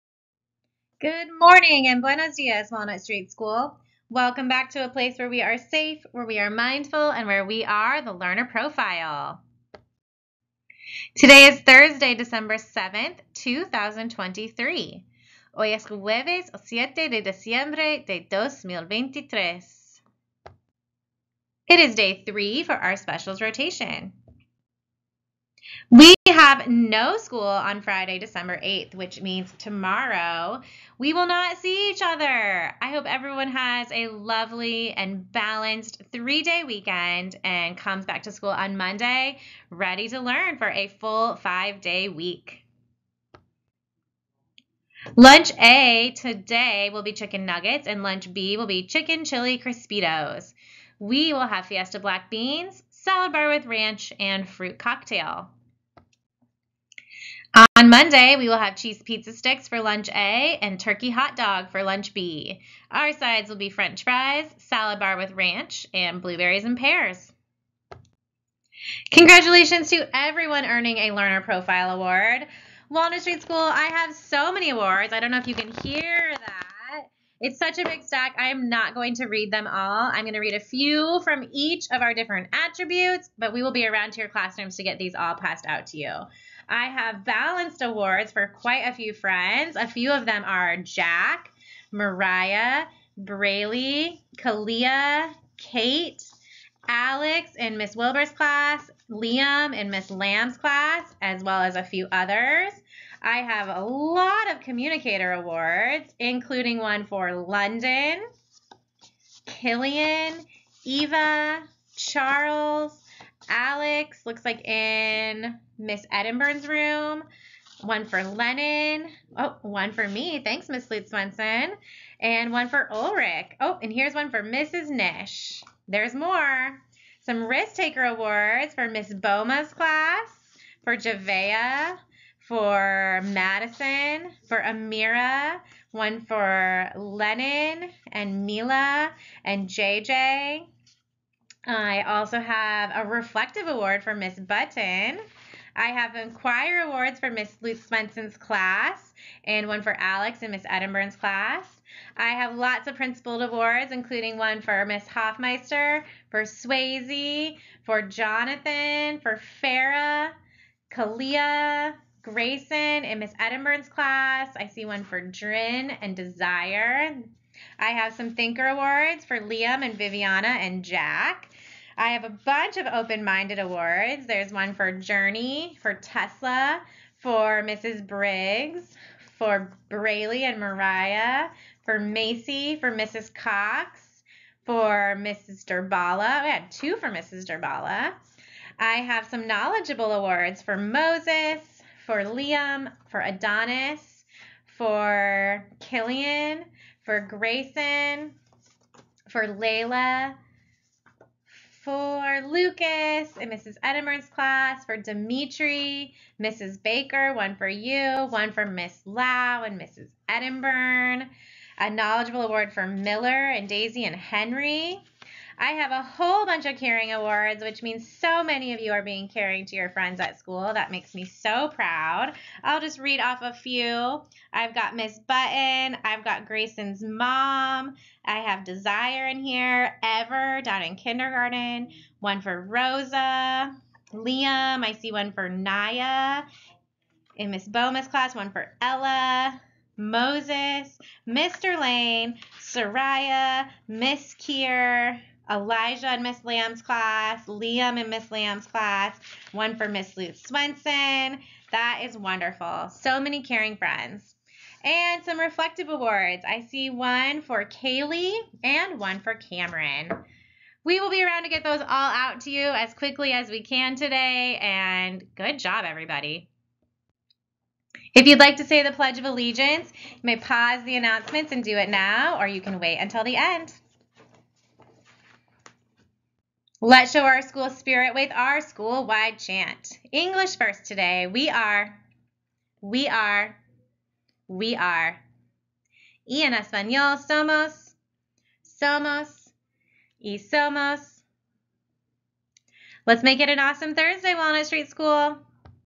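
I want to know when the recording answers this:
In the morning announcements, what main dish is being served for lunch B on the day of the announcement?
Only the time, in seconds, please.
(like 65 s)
48 s.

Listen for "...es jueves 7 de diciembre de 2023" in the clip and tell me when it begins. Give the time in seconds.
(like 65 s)
15 s.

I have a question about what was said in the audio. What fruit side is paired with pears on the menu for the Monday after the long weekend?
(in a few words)
Blueberries.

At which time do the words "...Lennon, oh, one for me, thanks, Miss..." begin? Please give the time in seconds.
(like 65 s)
118 s.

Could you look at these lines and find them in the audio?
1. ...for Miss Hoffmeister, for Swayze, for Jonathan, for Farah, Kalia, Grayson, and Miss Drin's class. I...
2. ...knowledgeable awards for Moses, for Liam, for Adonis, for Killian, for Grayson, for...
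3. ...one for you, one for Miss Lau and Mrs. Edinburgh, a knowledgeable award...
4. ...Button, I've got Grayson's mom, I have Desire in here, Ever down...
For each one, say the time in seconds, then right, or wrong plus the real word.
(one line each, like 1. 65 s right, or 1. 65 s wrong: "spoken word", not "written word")
1. 154 s wrong: "Edinburgh", not "Drin"
2. 189 s right
3. 207 s right
4. 225 s right.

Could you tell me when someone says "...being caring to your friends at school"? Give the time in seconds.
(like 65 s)
219 s.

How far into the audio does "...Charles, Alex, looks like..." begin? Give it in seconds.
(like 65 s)
111 s.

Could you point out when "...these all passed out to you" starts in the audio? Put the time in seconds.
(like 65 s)
84 s.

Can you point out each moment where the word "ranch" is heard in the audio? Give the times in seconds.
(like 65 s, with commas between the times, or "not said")
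53 s, 65 s.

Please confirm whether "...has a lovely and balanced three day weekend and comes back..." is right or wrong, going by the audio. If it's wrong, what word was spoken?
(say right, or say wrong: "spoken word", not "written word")
right.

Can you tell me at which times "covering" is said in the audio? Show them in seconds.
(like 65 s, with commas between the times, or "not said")
not said.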